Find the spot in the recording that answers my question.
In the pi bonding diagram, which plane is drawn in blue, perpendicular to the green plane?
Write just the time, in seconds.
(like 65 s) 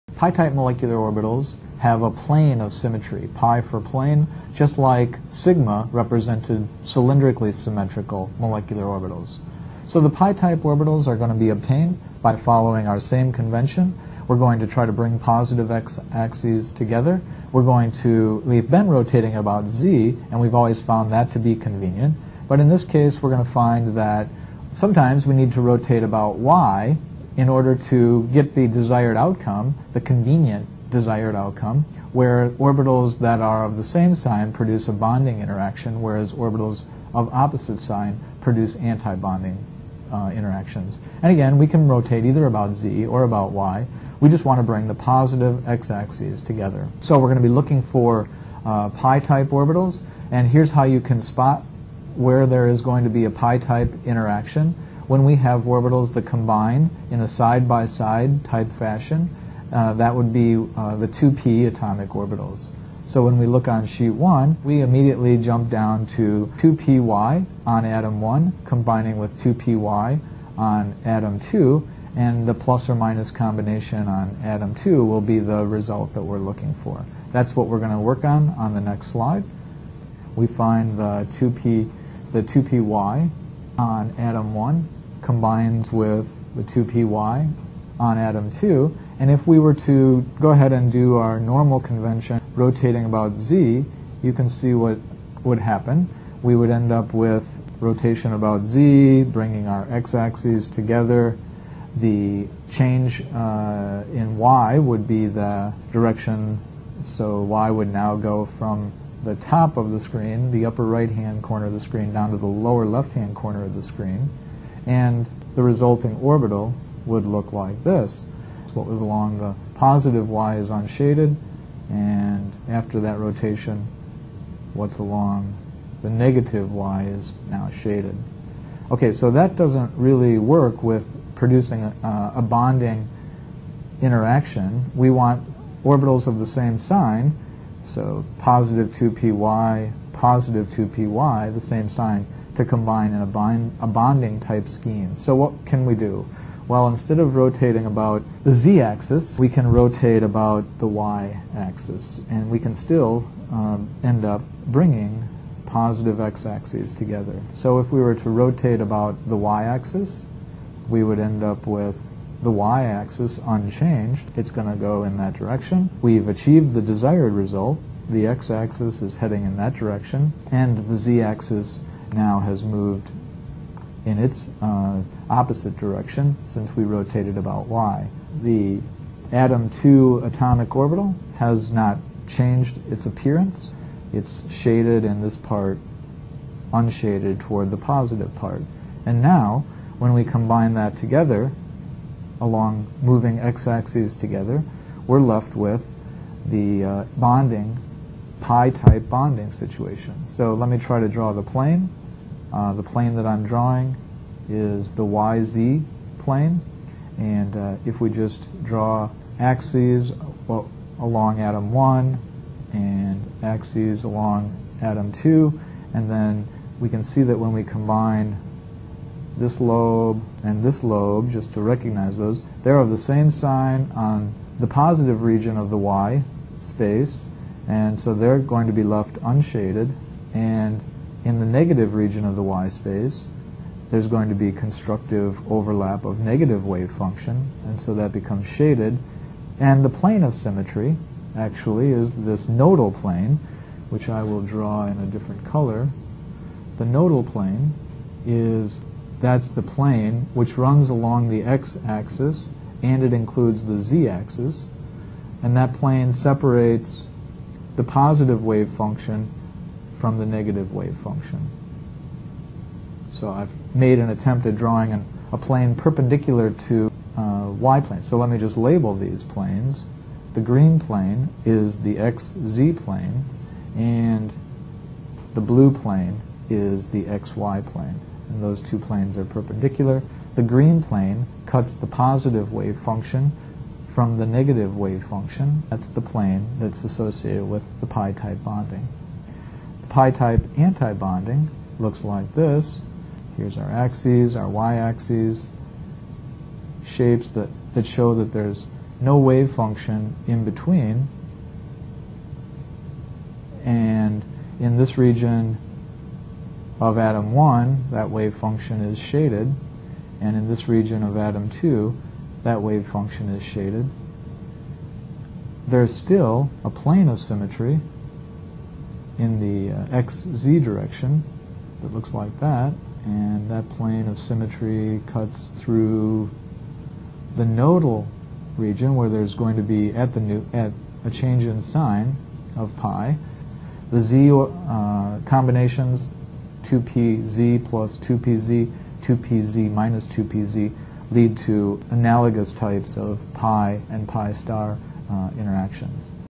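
277 s.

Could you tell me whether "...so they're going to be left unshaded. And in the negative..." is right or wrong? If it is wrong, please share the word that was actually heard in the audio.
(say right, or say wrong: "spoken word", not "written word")
right.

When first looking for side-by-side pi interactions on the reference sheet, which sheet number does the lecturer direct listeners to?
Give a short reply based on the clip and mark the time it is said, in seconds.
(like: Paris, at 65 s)
Sheet 1, at 63 s.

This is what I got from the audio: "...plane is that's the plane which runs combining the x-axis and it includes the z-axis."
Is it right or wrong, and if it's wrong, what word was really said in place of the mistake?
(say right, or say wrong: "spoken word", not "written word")
wrong: "along", not "combining".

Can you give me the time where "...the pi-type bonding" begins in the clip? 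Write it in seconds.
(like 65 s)
287 s.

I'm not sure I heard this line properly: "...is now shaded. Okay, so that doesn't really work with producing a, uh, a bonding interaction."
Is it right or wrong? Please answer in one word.
right.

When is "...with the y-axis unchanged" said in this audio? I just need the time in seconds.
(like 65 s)
161 s.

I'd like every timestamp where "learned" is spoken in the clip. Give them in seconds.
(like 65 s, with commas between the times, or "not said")
not said.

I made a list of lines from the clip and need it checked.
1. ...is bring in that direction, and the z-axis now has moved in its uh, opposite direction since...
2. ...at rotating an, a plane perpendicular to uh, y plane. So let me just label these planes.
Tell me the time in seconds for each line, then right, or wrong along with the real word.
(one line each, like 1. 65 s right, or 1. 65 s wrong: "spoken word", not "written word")
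1. 169 s wrong: "heading", not "bring"
2. 264 s wrong: "drawing", not "rotating".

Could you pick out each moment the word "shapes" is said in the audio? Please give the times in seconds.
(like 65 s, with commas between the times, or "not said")
296 s.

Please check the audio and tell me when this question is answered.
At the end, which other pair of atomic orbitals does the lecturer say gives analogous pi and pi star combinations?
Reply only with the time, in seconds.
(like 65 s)
336 s.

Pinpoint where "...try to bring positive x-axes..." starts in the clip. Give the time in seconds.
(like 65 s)
14 s.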